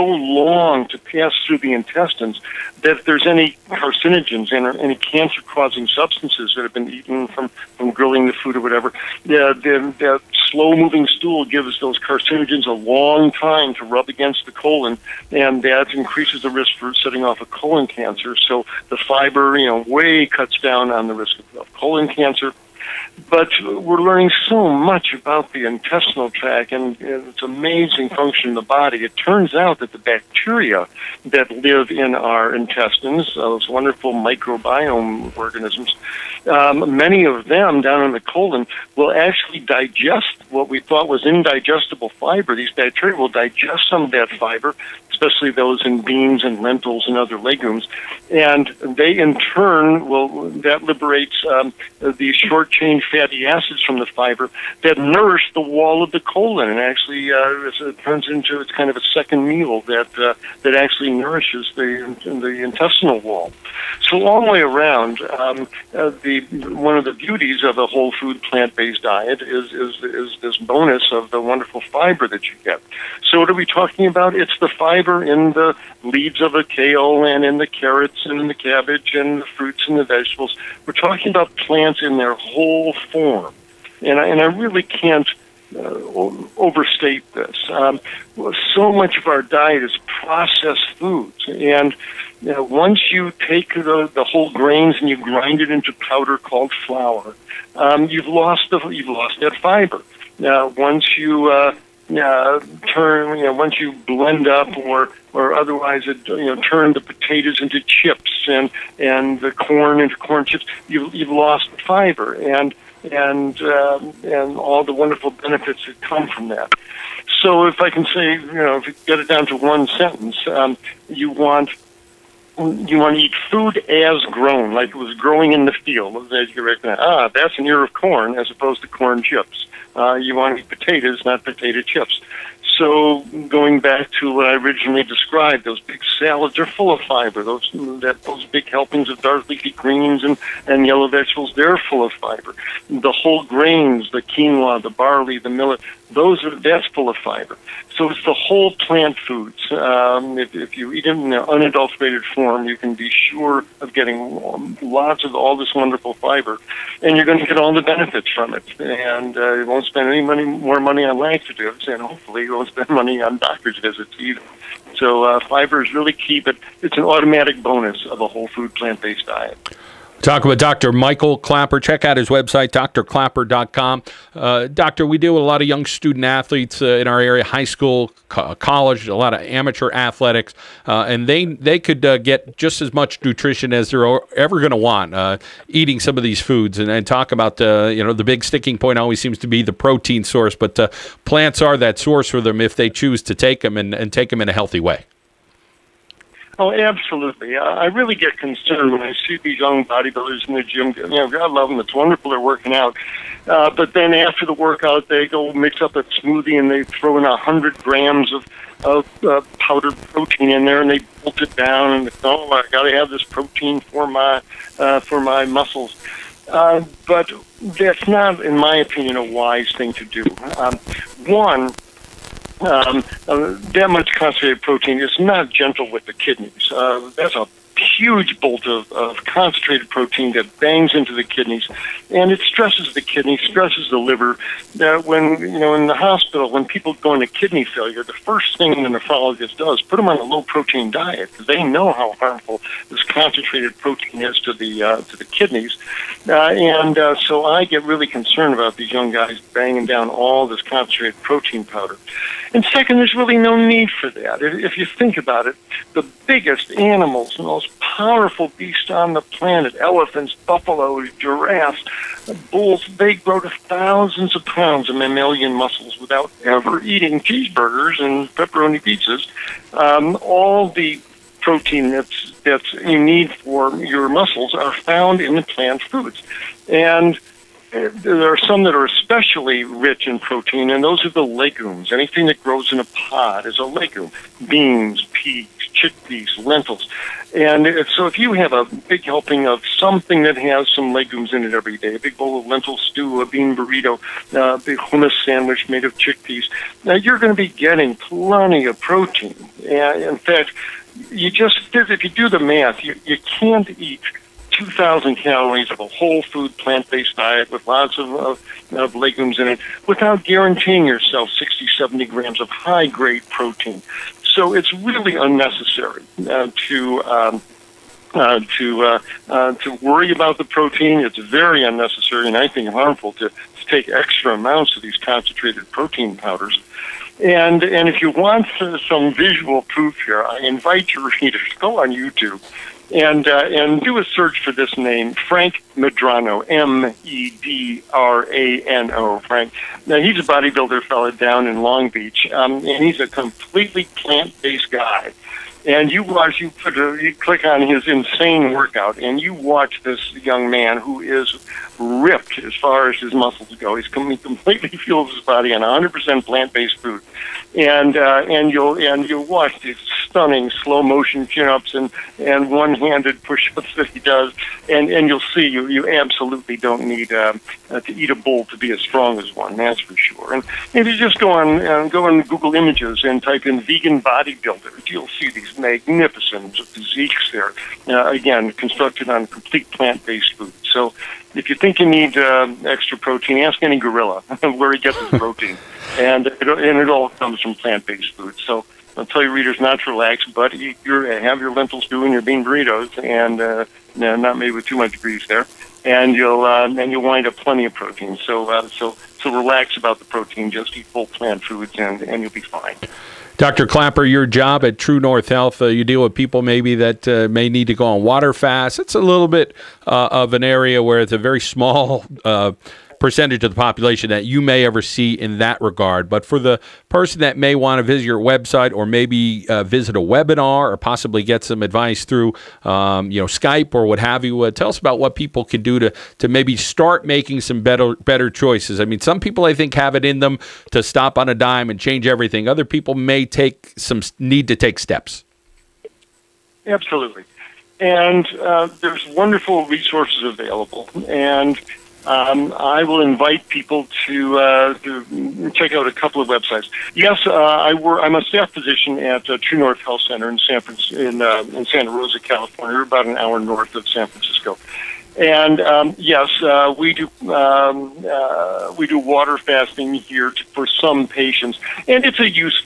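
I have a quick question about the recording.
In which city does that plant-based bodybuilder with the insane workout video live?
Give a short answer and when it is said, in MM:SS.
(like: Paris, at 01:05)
Long Beach, at 05:41.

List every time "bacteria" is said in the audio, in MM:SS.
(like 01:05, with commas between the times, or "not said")
00:29, 00:42.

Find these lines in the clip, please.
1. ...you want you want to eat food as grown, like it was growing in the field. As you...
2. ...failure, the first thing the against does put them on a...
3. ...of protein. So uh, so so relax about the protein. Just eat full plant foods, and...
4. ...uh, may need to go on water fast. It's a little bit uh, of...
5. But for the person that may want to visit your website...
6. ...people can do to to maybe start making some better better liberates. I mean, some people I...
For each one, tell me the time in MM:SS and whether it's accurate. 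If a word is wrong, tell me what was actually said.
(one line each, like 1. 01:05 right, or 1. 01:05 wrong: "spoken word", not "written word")
1. 02:01 right
2. 03:57 wrong: "nephrologist", not "against"
3. 06:37 right
4. 06:47 right
5. 06:56 right
6. 07:05 wrong: "choices", not "liberates".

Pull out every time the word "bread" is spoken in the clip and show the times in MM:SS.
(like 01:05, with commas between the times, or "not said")
not said.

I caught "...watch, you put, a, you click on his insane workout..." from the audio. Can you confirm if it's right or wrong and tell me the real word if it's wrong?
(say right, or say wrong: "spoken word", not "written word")
right.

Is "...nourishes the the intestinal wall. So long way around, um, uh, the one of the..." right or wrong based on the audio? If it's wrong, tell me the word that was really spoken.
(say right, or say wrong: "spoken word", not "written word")
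right.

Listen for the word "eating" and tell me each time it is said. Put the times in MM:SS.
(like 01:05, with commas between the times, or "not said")
03:05, 04:26.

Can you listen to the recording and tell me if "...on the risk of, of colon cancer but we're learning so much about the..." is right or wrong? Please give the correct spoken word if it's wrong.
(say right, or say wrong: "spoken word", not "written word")
right.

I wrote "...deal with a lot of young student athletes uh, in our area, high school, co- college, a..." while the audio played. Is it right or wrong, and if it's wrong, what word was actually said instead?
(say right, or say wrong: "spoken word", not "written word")
right.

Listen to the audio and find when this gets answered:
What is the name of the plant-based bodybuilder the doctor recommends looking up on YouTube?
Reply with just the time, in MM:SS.
05:35.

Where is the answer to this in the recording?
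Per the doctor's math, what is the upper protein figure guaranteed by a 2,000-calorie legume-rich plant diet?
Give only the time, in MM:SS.
05:11.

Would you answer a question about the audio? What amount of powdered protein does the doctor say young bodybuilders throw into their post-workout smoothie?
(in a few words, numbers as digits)
100 grams.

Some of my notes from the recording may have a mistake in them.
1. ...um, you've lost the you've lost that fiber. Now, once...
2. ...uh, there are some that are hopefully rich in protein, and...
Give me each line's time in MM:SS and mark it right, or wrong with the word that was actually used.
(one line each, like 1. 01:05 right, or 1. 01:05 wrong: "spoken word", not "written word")
1. 01:37 right
2. 04:37 wrong: "especially", not "hopefully".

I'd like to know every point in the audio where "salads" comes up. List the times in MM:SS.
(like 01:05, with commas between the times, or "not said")
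02:16.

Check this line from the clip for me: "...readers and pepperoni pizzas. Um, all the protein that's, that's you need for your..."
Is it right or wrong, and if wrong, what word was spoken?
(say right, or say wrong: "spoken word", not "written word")
wrong: "cheeseburgers", not "readers".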